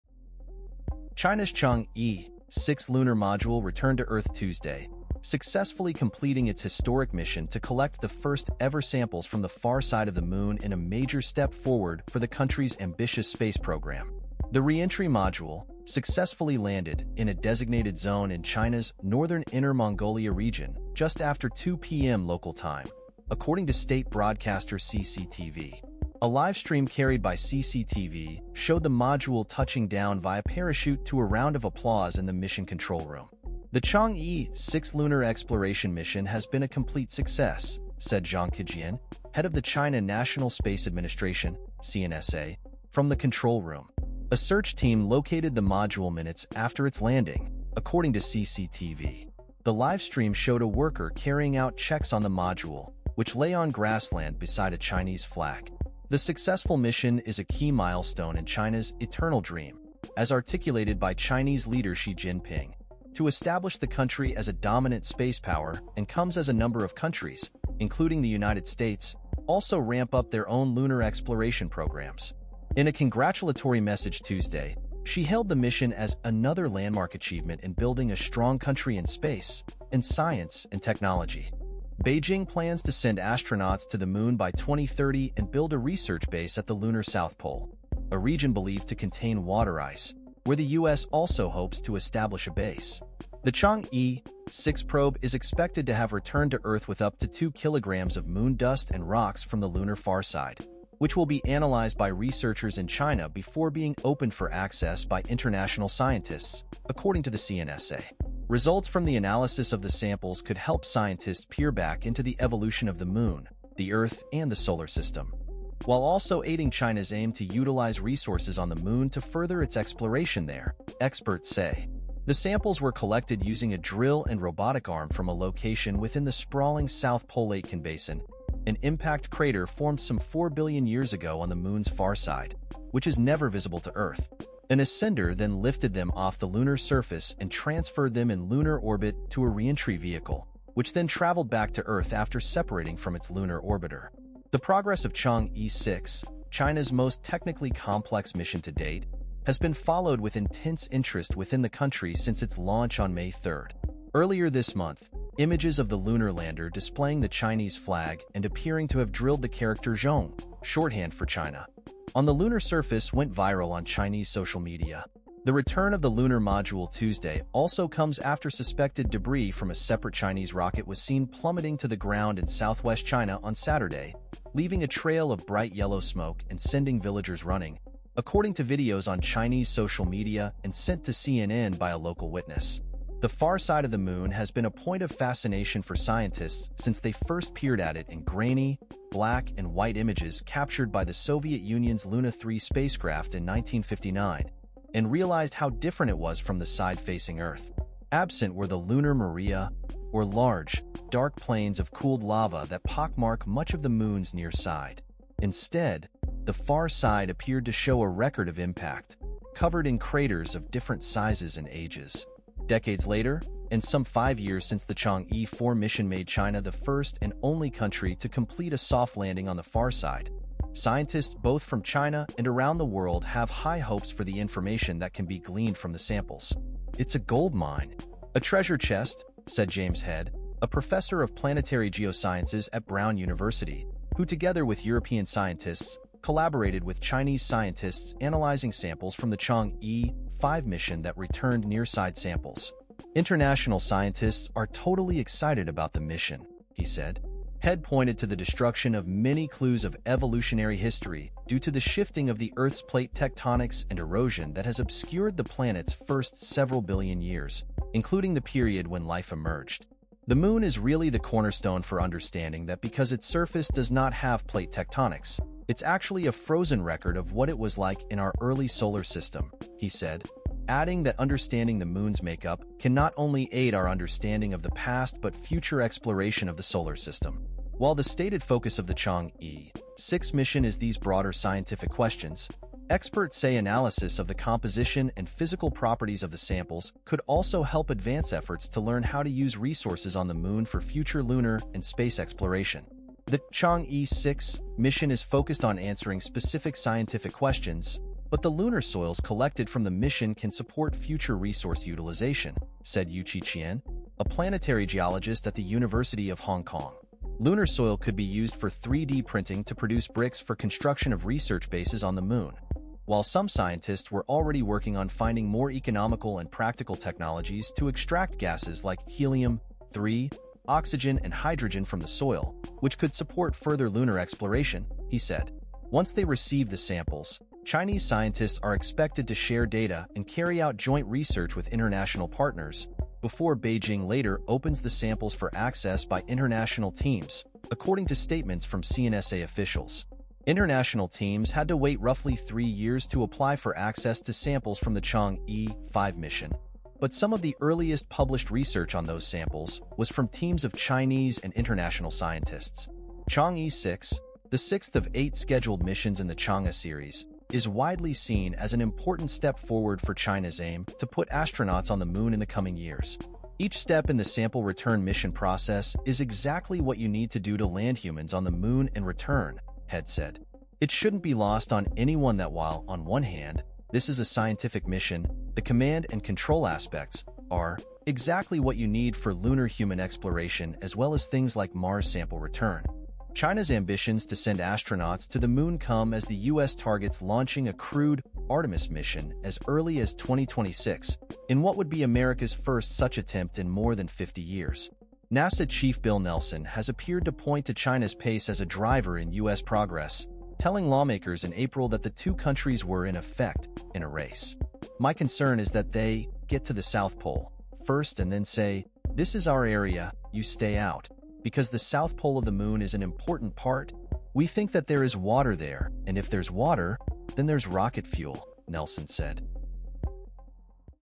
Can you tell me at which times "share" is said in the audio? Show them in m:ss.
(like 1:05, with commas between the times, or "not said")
5:29.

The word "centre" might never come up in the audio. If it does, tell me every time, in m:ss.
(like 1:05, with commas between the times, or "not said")
not said.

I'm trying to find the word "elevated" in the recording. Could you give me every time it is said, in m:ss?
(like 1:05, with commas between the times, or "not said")
not said.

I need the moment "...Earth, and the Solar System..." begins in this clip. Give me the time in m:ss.
1:53.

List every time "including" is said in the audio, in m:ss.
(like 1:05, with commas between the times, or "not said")
1:07, 4:17.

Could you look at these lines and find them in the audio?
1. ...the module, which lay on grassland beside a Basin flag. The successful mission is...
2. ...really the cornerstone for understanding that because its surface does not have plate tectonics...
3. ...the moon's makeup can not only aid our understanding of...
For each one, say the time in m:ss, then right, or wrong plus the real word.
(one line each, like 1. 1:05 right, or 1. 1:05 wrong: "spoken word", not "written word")
1. 0:52 wrong: "Chinese", not "Basin"
2. 4:20 right
3. 4:31 right.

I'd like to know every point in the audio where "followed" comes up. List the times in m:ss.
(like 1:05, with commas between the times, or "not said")
2:29.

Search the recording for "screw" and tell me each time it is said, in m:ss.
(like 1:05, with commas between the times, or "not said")
not said.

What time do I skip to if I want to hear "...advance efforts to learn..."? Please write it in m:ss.
4:47.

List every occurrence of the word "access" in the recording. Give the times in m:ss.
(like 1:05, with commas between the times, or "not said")
1:44, 5:35, 5:43.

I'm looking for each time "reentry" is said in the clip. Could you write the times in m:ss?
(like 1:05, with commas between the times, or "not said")
0:14, 2:19.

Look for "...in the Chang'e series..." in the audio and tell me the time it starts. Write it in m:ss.
5:56.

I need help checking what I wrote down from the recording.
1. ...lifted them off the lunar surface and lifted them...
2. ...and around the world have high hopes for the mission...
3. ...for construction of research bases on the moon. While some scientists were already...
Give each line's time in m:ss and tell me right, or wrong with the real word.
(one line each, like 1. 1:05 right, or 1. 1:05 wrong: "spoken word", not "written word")
1. 2:15 wrong: "transferred", not "lifted"
2. 3:42 wrong: "information", not "mission"
3. 5:10 right.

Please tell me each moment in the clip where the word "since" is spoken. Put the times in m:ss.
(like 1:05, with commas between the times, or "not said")
2:32, 3:06, 3:34.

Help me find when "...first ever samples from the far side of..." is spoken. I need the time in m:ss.
0:08.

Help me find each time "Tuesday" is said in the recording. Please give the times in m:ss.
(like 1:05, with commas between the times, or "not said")
0:04, 1:14, 2:46.